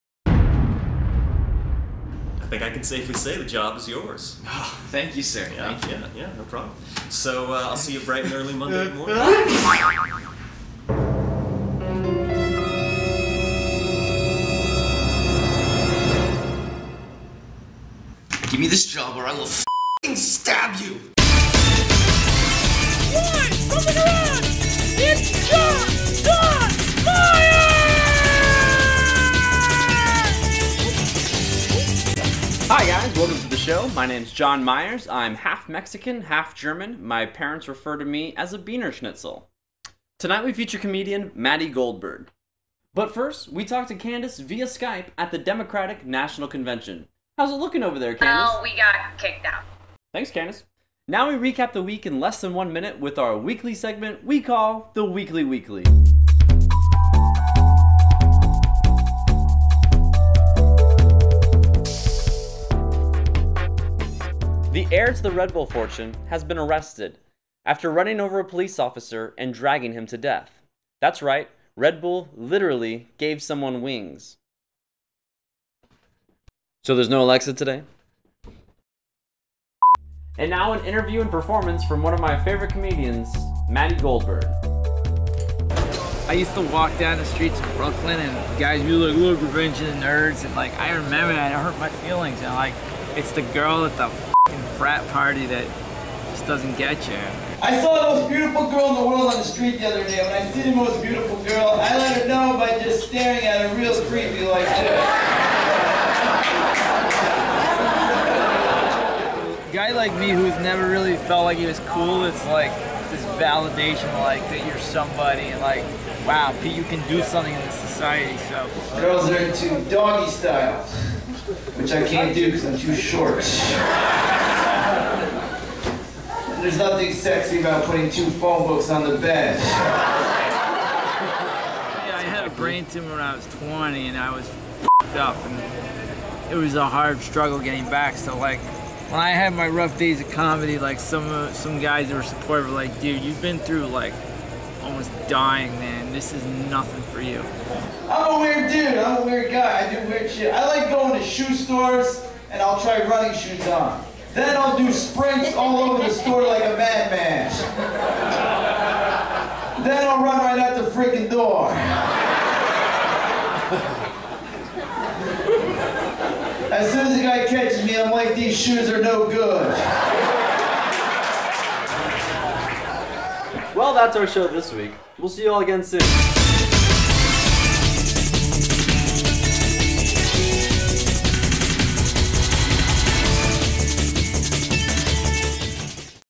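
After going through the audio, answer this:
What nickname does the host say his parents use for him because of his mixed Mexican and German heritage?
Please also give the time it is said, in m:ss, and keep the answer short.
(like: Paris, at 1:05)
Beaner Schnitzel, at 0:38.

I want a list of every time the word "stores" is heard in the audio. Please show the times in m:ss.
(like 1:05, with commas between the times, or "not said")
2:31, 2:36.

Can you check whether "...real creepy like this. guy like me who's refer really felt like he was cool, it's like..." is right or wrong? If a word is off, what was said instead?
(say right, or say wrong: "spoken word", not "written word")
wrong: "never", not "refer".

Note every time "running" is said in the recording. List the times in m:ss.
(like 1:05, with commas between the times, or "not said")
1:07, 2:33.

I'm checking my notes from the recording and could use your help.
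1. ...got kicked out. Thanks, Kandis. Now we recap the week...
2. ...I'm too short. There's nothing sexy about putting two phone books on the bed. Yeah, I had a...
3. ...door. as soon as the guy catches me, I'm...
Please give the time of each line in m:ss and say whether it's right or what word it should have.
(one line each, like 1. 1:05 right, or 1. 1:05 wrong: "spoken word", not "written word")
1. 0:48 right
2. 2:02 right
3. 2:41 right.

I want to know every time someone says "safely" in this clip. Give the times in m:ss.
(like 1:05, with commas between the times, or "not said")
0:02.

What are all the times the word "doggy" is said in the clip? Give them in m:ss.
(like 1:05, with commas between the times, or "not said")
1:59.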